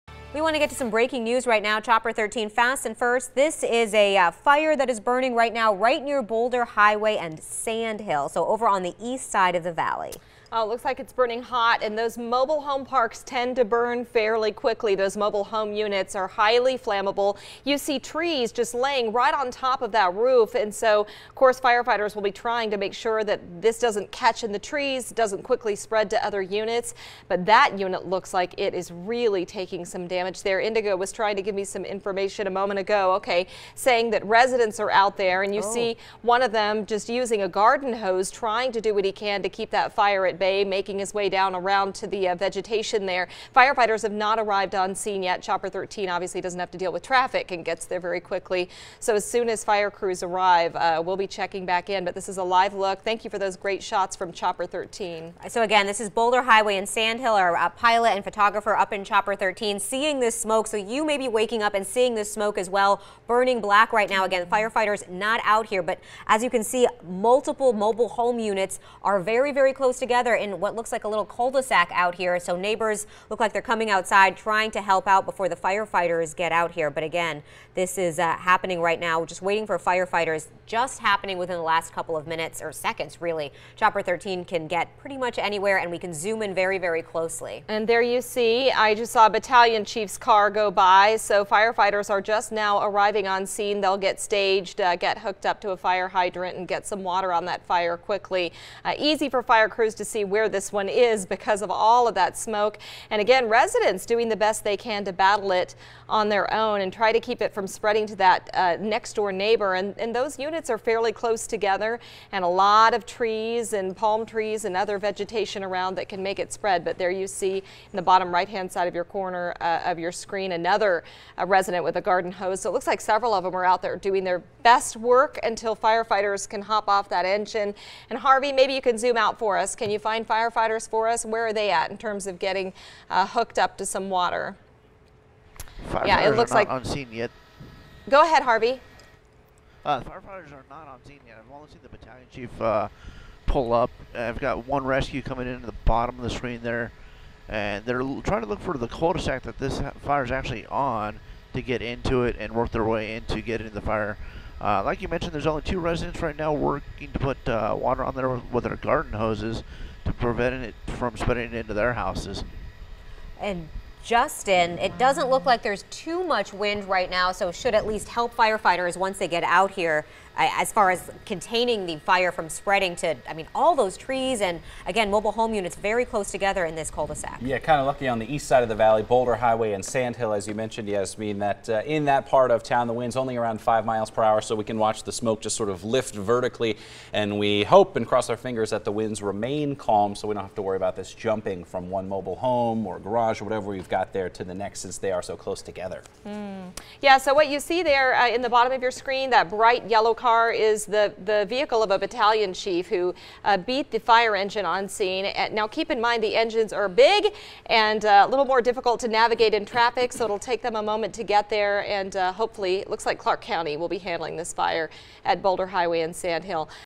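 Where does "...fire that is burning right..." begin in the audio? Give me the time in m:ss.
0:04.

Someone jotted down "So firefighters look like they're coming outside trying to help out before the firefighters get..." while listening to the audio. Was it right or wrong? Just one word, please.
wrong.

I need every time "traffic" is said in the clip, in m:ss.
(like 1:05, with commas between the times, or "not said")
0:47, 3:29.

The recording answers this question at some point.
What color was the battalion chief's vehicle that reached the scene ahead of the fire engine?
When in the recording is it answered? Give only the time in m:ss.
3:19.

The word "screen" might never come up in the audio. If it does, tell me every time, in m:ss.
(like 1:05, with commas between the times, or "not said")
2:00, 2:26, 3:18.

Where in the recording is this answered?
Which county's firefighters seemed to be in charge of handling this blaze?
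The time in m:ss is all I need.
3:33.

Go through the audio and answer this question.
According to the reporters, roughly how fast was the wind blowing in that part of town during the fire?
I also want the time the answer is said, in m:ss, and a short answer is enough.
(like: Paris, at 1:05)
5 miles per hour, at 3:03.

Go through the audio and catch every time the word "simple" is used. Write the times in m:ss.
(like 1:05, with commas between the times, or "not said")
not said.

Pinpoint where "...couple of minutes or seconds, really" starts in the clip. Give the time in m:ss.
1:21.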